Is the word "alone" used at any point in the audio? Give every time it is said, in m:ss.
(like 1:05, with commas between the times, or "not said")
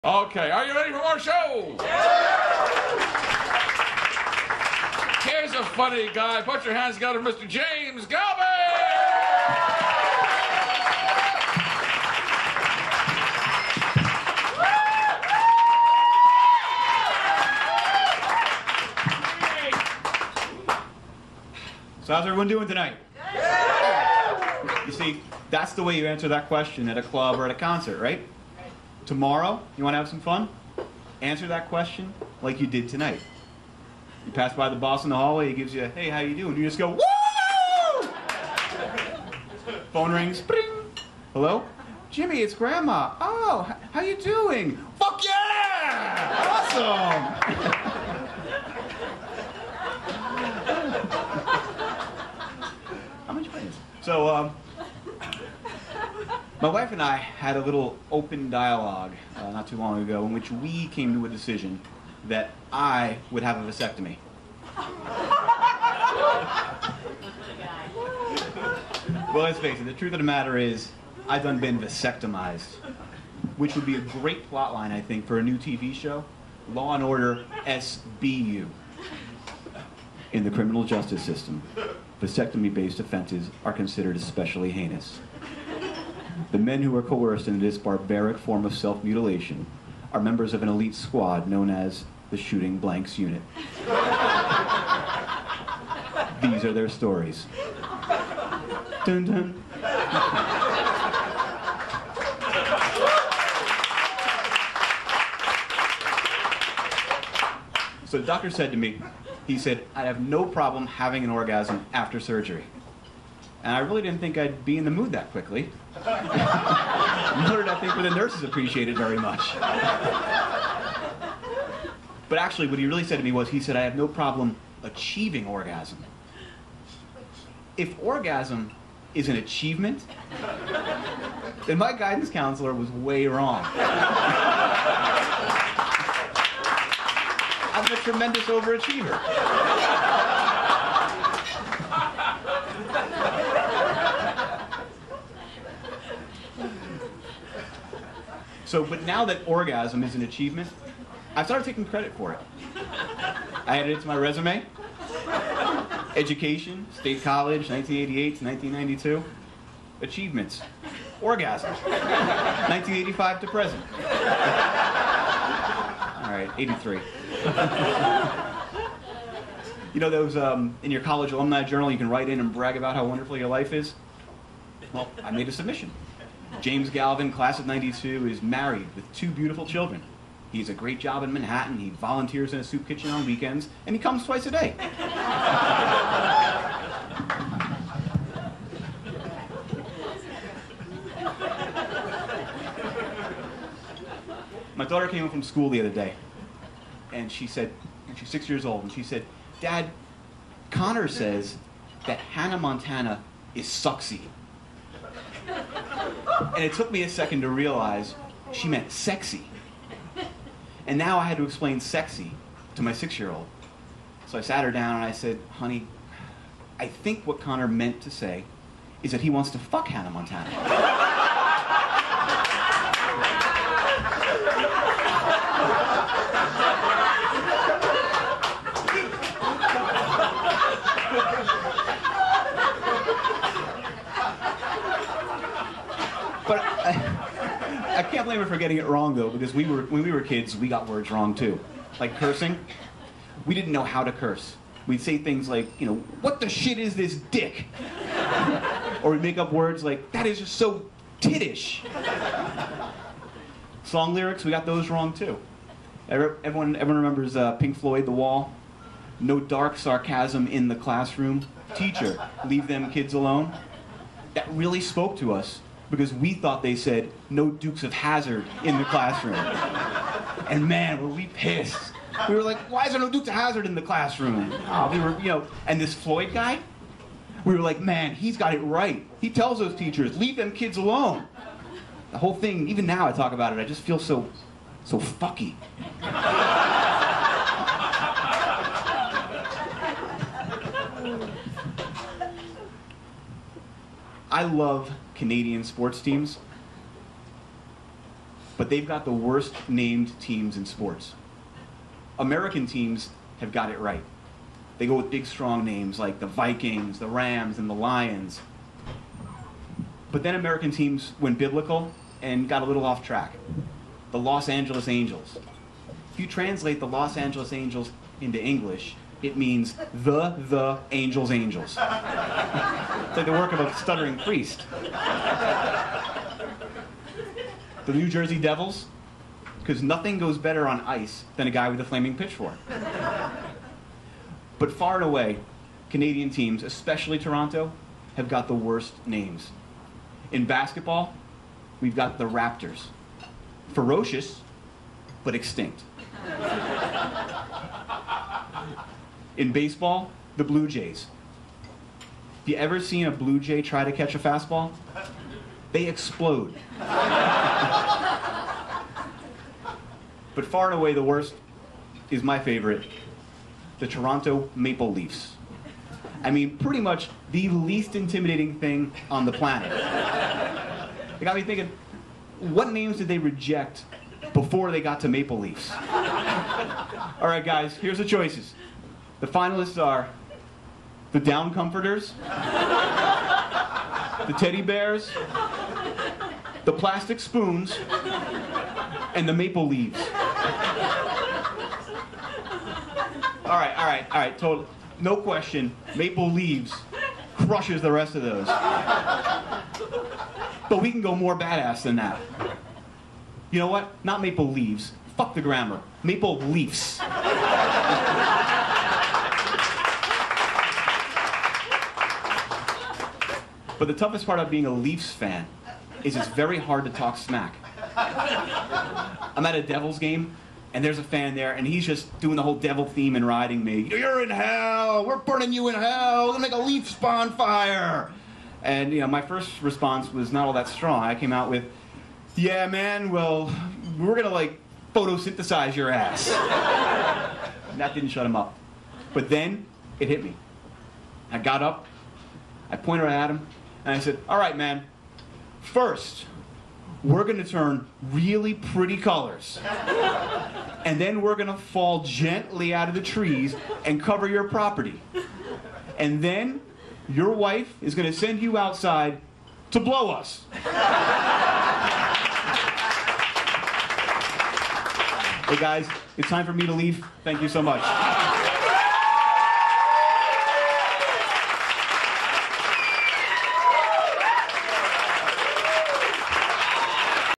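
4:23, 4:40.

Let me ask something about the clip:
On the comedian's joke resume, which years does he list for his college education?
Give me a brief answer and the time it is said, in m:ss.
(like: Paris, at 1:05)
1988 to 1992, at 2:37.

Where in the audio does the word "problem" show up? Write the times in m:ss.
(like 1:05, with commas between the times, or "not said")
1:50, 2:04.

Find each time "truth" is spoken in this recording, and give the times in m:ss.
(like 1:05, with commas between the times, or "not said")
1:09.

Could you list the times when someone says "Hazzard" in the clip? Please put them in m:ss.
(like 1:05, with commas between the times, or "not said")
4:27, 4:33.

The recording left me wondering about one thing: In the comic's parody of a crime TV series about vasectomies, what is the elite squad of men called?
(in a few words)
Shooting Blanks Unit.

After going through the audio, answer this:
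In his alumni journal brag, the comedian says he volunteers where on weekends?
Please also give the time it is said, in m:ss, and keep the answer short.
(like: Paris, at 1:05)
A soup kitchen, at 3:02.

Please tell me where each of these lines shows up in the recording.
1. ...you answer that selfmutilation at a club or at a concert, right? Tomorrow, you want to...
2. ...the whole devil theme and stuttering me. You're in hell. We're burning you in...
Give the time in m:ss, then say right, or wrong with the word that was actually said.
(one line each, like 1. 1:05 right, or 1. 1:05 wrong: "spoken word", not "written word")
1. 0:25 wrong: "question", not "selfmutilation"
2. 7:02 wrong: "riding", not "stuttering".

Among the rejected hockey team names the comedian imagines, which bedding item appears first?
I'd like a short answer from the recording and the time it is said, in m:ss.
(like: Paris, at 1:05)
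The down comforters, at 6:21.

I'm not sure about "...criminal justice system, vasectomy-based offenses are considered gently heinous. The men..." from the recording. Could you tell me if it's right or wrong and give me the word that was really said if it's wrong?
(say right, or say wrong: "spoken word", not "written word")
wrong: "especially", not "gently".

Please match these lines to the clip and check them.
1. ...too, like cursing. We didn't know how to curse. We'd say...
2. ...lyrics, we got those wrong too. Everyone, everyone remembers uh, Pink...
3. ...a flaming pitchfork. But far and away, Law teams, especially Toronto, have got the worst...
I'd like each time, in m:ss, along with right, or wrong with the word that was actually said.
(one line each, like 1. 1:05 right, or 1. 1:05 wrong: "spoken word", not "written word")
1. 4:01 right
2. 4:14 right
3. 5:31 wrong: "Canadian", not "Law".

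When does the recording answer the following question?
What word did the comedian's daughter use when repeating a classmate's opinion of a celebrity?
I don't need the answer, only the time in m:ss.
3:23.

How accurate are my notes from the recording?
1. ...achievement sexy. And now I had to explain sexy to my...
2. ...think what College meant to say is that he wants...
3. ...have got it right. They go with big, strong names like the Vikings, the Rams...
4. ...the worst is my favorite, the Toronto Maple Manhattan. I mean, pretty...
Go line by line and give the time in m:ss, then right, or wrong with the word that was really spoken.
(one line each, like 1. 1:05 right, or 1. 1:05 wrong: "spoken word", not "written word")
1. 3:28 wrong: "meant", not "achievement"
2. 3:36 wrong: "Connor", not "College"
3. 5:03 right
4. 6:00 wrong: "Leafs", not "Manhattan".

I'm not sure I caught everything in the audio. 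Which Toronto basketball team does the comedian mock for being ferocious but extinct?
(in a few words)
The Raptors.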